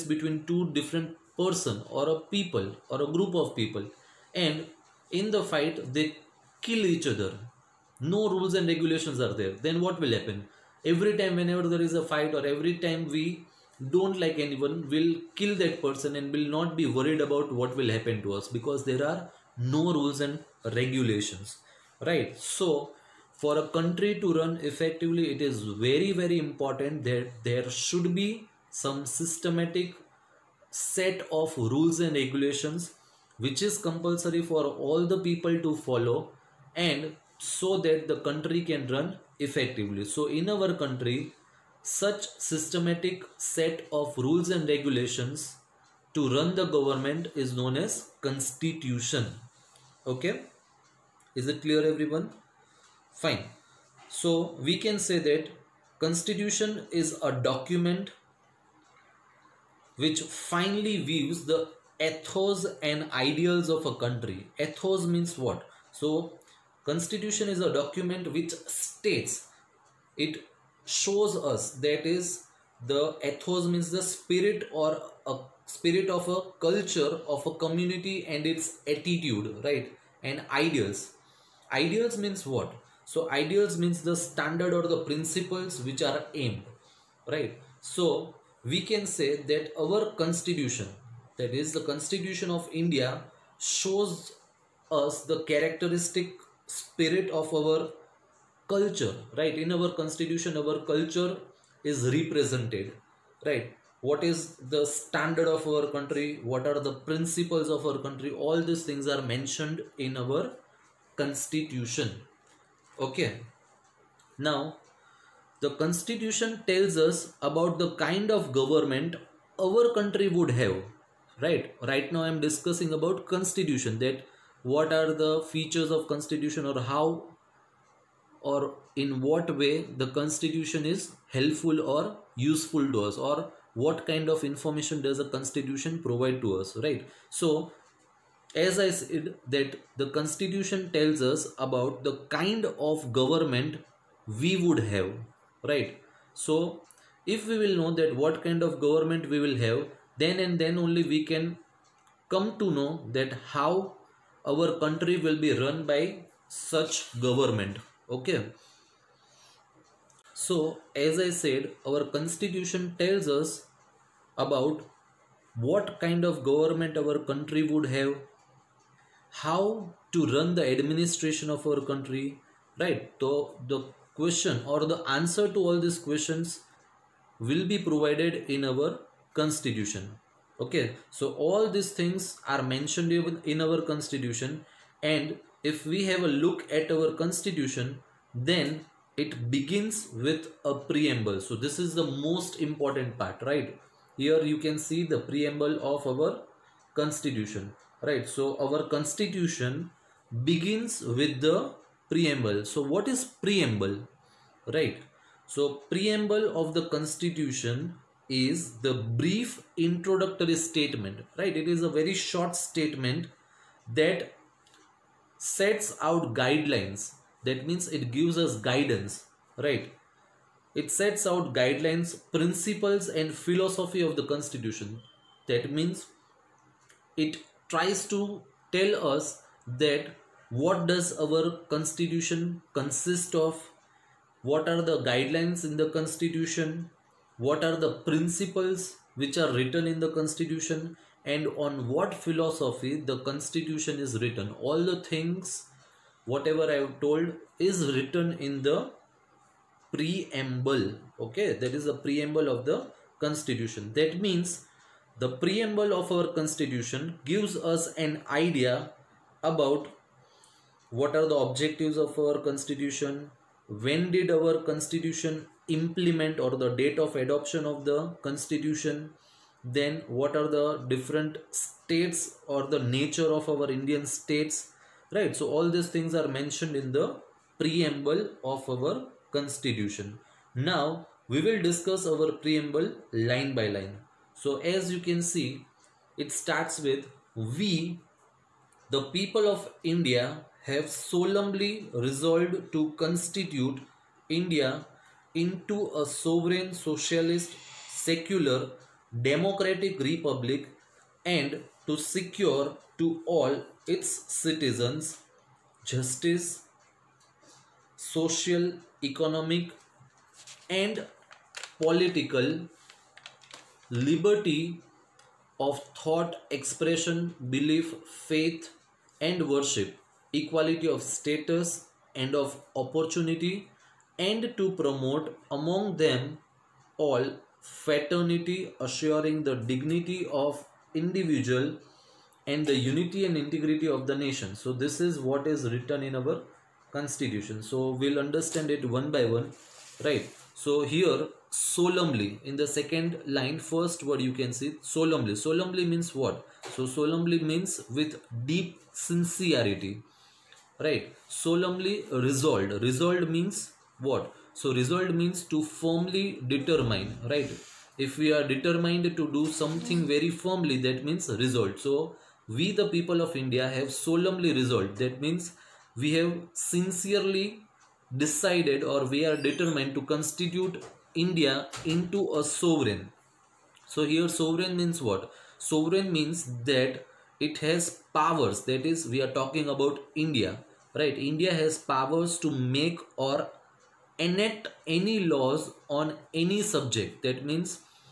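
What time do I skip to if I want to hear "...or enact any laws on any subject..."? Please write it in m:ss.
6:23.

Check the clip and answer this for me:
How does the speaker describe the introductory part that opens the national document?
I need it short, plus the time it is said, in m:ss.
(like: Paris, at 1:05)
brief introductory statement, at 3:29.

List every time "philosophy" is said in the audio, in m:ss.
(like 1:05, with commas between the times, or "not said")
3:43, 4:02.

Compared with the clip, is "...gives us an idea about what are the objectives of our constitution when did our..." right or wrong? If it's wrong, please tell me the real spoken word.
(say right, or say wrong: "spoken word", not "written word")
right.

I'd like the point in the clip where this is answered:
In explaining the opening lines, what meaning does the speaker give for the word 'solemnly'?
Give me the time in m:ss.
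5:47.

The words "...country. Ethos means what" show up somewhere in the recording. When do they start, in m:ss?
1:04.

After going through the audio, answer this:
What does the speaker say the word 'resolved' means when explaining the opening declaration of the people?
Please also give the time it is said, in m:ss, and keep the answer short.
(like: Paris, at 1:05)
to firmly determine, at 5:55.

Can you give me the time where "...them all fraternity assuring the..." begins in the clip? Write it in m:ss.
5:25.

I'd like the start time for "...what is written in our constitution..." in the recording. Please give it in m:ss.
5:35.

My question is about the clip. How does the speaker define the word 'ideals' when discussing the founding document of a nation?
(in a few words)
principles which are aimed.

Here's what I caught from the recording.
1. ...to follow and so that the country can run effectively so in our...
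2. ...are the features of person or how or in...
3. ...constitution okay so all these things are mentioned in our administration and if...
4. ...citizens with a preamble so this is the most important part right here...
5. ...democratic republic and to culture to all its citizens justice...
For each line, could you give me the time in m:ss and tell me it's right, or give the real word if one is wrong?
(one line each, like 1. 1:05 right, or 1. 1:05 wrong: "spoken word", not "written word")
1. 0:35 right
2. 2:04 wrong: "constitution", not "person"
3. 2:59 wrong: "constitution", not "administration"
4. 3:09 wrong: "begins", not "citizens"
5. 4:59 wrong: "secure", not "culture".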